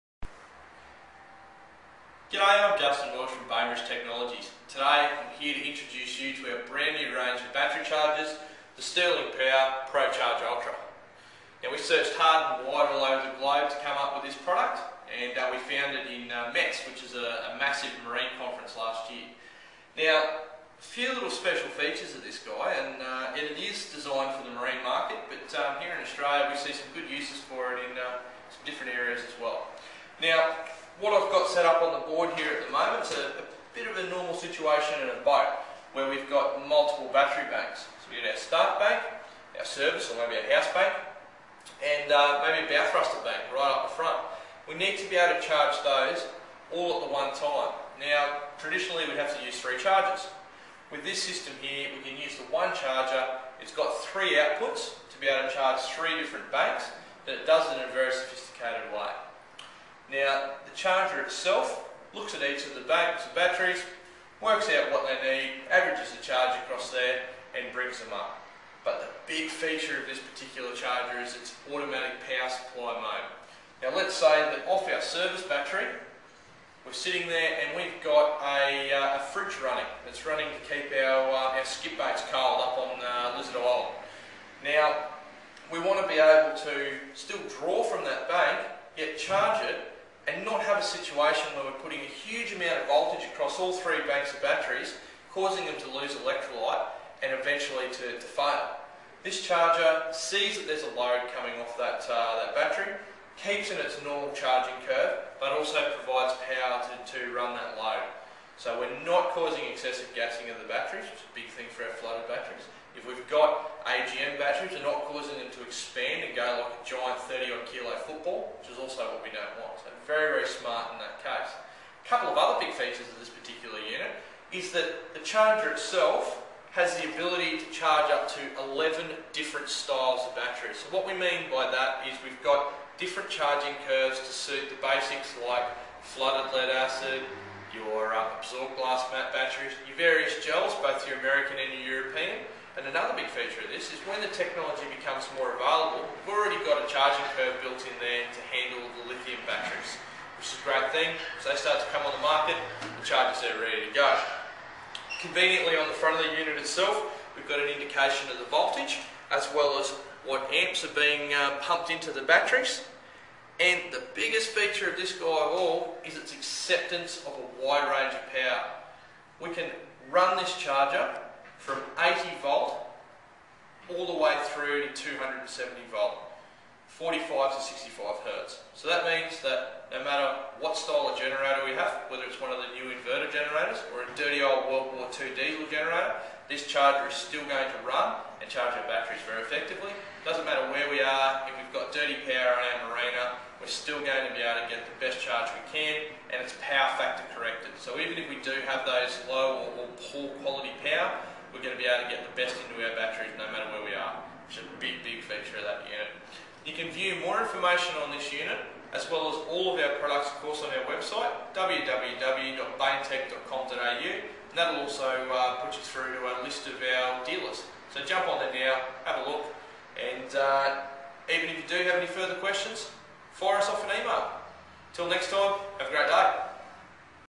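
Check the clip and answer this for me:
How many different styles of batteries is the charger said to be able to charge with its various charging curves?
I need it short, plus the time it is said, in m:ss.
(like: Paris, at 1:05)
11, at 2:08.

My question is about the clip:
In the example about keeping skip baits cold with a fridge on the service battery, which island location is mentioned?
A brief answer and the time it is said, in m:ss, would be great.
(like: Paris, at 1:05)
Lizard Island, at 1:23.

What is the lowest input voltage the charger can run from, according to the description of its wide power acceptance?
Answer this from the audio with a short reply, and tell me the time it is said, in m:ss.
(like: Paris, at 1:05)
80 volt, at 2:51.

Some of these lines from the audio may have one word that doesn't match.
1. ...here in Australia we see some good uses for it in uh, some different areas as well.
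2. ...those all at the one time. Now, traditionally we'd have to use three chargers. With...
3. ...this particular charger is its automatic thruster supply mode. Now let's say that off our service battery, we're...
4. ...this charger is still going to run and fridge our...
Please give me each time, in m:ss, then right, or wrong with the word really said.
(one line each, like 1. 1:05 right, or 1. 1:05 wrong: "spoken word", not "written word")
1. 0:25 right
2. 0:45 right
3. 1:10 wrong: "power", not "thruster"
4. 3:06 wrong: "charge", not "fridge".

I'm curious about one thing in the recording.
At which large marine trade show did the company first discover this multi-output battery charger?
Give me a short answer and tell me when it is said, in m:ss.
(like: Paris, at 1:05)
METS, at 0:16.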